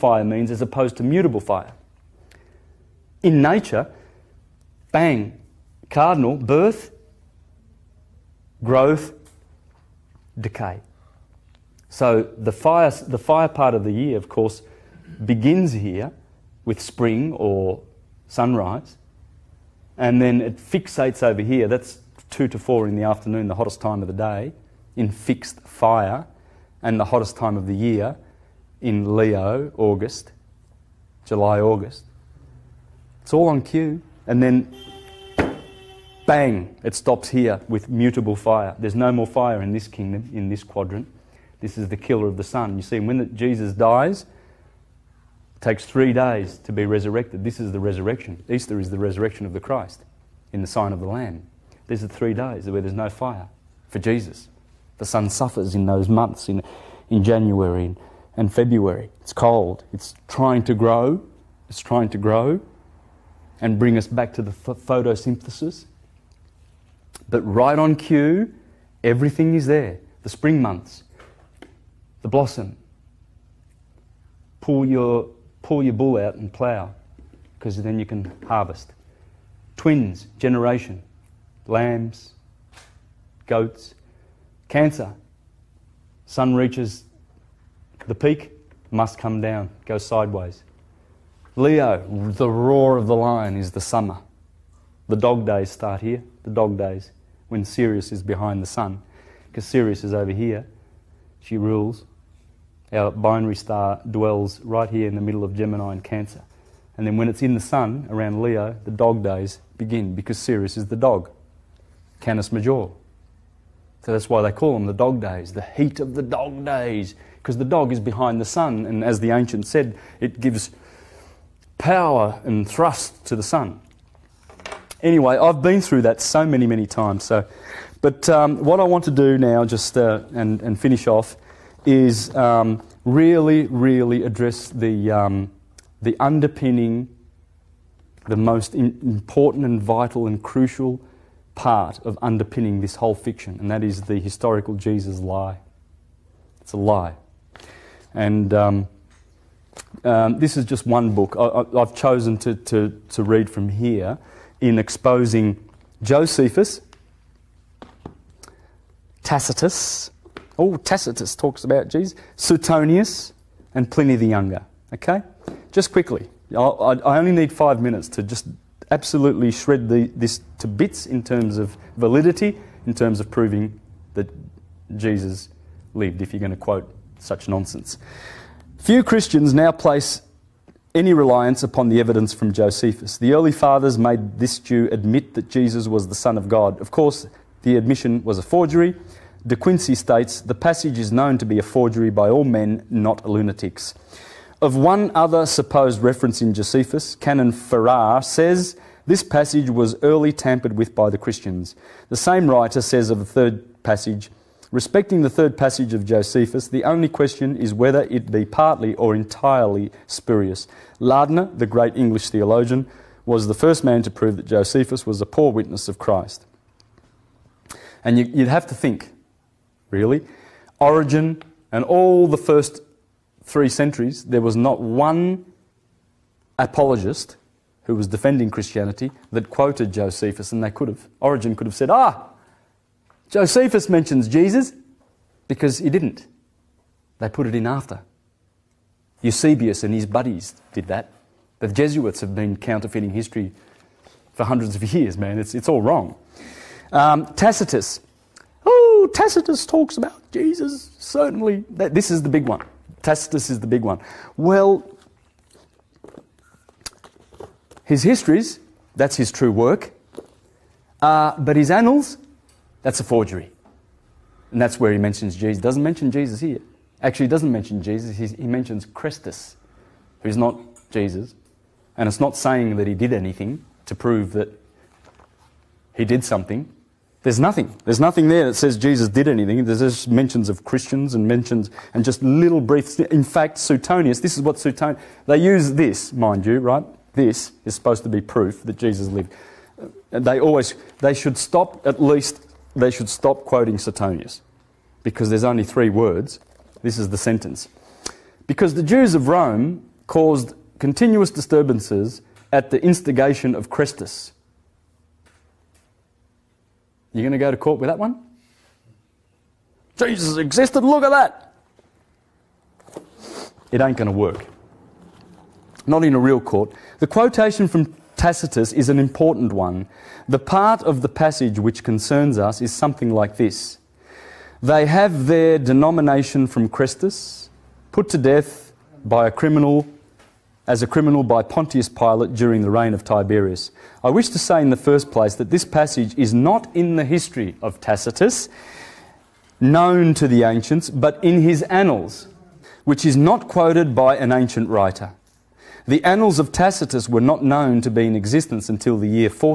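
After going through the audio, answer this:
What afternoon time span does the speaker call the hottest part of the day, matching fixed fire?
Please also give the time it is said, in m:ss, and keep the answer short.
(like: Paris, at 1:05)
2 to 4, at 0:22.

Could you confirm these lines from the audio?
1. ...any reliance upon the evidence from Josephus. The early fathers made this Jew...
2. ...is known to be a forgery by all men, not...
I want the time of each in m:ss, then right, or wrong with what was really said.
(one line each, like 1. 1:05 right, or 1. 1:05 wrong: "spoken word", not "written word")
1. 3:00 right
2. 3:10 right.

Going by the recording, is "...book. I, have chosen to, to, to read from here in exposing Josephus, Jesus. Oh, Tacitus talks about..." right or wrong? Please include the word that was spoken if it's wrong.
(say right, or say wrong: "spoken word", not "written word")
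wrong: "Tacitus", not "Jesus".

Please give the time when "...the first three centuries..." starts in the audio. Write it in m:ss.
3:42.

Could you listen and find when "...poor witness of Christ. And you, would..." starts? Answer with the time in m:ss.
3:35.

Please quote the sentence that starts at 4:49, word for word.
Uh, they always, they should stop, at least, they should stop quoting Suetonius because there's only three words.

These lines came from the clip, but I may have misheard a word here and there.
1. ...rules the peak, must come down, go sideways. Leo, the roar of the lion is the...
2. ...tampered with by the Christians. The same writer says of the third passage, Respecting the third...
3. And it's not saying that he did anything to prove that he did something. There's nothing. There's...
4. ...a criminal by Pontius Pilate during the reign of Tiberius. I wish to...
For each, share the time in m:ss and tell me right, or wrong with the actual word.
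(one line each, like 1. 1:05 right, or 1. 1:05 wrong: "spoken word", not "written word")
1. 1:26 wrong: "reaches", not "rules"
2. 3:20 right
3. 4:31 right
4. 5:30 right.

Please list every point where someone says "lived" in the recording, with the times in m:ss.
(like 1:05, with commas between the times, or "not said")
2:55, 4:49.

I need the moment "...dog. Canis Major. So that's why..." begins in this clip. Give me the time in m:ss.
1:50.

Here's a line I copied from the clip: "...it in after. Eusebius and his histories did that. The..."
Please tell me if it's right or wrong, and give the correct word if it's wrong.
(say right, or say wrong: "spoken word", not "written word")
wrong: "buddies", not "histories".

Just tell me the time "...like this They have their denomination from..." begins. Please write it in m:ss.
5:23.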